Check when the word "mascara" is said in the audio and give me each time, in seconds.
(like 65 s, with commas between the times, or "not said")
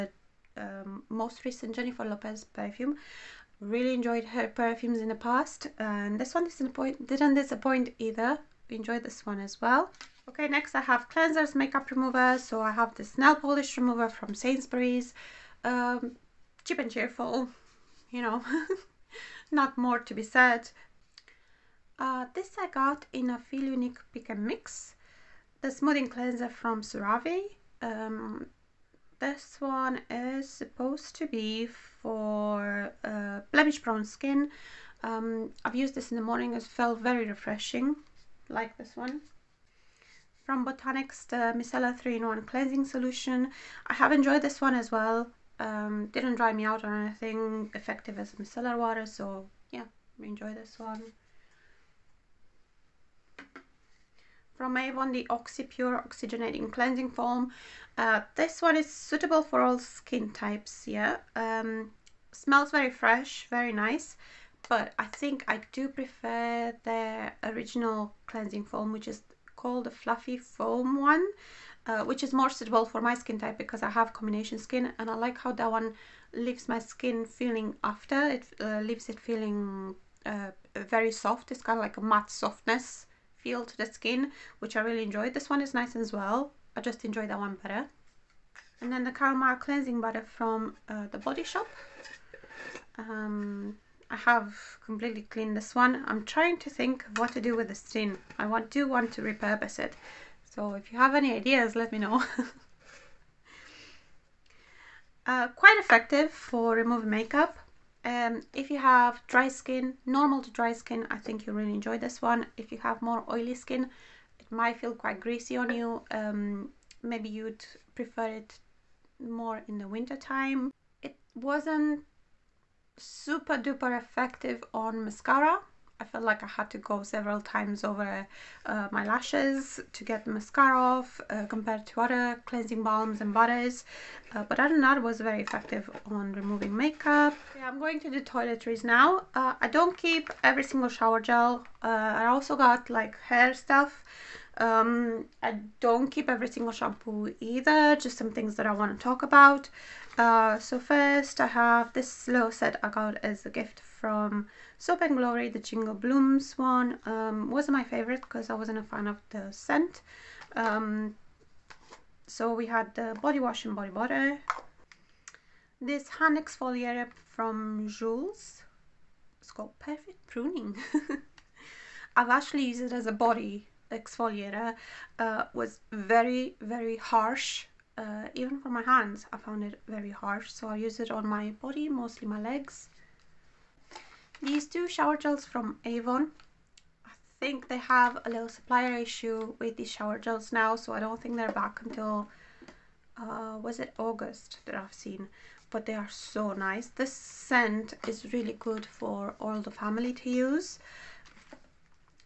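125 s, 130 s.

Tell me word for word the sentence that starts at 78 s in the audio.
It uh, leaves it feeling uh, very soft.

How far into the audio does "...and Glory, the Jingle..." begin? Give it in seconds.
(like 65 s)
155 s.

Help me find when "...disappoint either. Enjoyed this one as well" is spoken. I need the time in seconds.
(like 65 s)
7 s.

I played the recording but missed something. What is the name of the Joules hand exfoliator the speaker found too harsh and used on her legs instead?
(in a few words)
Perfect Pruning.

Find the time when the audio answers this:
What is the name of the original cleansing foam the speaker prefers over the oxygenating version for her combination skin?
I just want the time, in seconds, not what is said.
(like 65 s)
69 s.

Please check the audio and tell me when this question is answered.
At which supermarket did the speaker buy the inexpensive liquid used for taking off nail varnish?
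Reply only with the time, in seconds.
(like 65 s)
14 s.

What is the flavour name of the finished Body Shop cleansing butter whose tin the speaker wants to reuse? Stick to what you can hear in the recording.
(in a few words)
Caramel.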